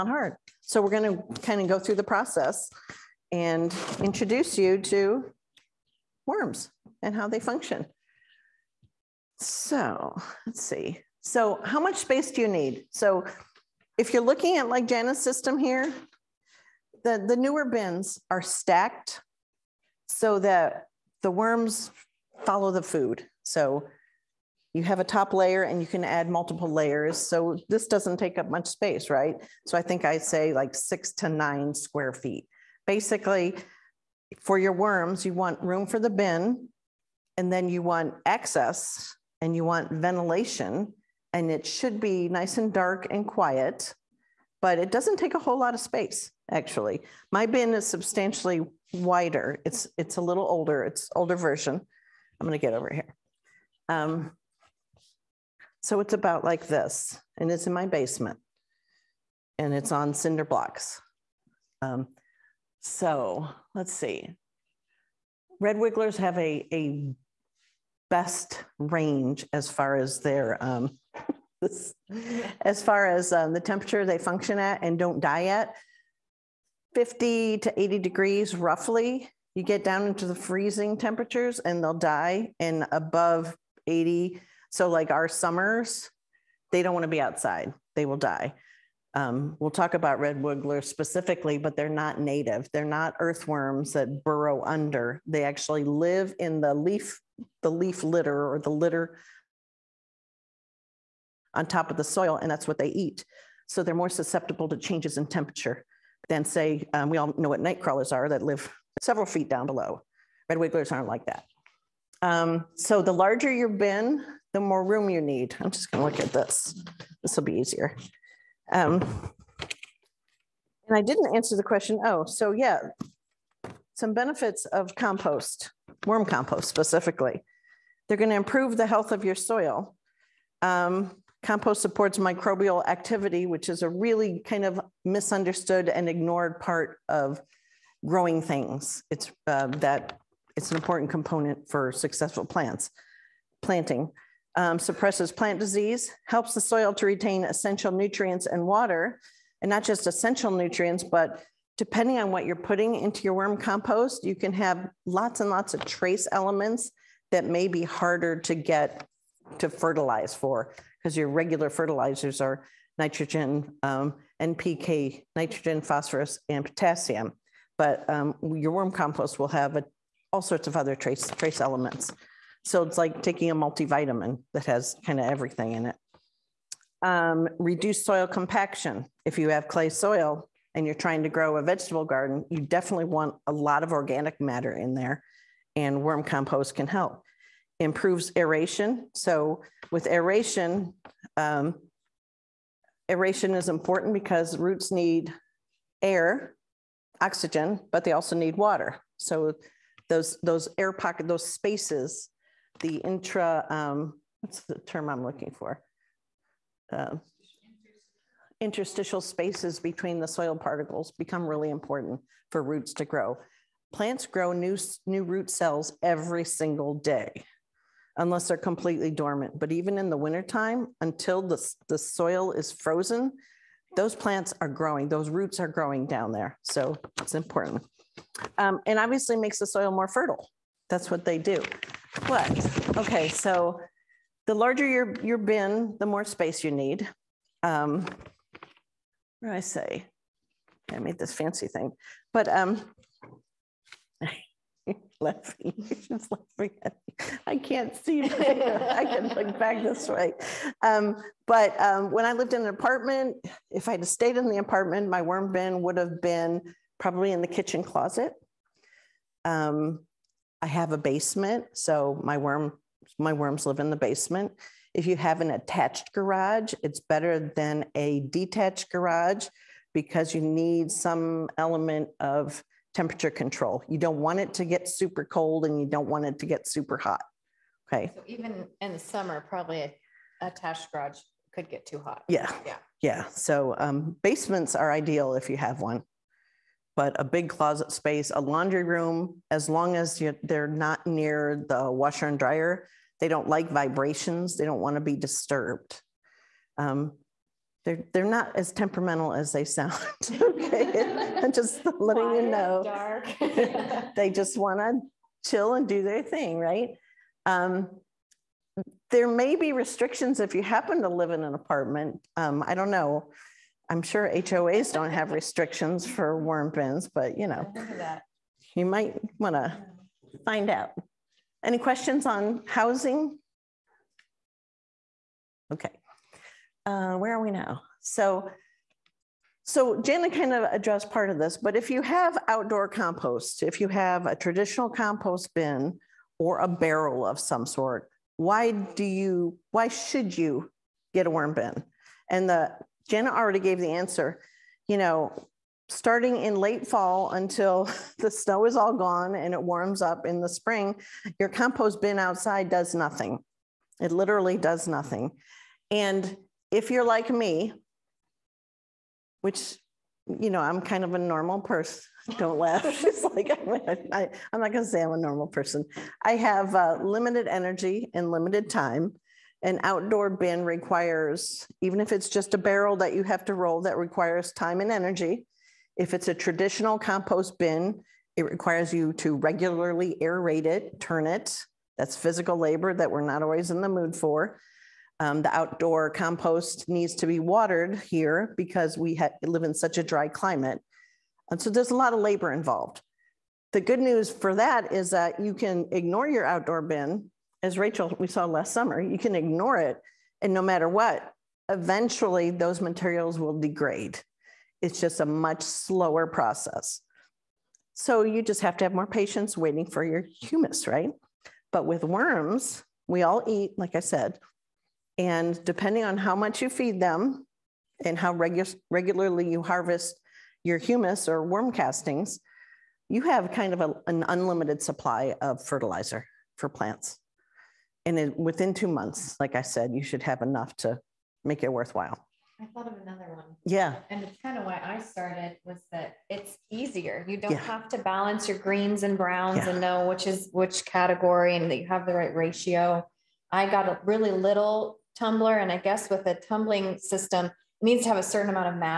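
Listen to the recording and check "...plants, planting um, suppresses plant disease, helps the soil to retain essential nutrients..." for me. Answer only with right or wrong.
right.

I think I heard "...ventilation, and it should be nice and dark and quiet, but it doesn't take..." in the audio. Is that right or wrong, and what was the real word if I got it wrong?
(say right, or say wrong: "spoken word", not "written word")
right.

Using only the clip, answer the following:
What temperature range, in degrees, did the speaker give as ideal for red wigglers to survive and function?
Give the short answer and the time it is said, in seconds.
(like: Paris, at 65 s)
50 to 80 degrees, at 76 s.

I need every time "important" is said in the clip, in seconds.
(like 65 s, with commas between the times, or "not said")
140 s, 193 s, 211 s, 227 s.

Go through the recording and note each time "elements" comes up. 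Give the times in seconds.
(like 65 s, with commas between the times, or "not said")
156 s, 171 s, 271 s.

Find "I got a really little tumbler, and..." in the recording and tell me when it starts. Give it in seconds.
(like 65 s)
443 s.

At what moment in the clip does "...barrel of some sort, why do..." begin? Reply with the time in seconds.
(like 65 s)
336 s.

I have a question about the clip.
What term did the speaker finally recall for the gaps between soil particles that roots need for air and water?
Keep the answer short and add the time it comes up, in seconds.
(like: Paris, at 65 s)
interstitial spaces, at 208 s.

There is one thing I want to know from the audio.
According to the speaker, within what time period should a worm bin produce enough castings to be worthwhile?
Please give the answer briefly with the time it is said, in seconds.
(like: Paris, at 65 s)
2 months, at 428 s.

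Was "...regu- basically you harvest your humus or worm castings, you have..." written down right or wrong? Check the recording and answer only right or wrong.
wrong.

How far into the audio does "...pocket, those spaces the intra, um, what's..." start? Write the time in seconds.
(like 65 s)
200 s.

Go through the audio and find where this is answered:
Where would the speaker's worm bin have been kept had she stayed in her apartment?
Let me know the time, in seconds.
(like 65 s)
257 s.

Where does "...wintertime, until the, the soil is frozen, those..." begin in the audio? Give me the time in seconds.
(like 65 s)
220 s.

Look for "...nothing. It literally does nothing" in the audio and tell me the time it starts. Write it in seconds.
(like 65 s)
352 s.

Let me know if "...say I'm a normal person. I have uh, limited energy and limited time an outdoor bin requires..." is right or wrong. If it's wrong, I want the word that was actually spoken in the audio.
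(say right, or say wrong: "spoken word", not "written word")
right.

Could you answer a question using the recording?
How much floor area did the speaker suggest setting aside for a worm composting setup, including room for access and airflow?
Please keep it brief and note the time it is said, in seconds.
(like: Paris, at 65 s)
6 to 9 square feet, at 30 s.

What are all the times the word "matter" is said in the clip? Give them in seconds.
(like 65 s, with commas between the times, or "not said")
184 s, 400 s.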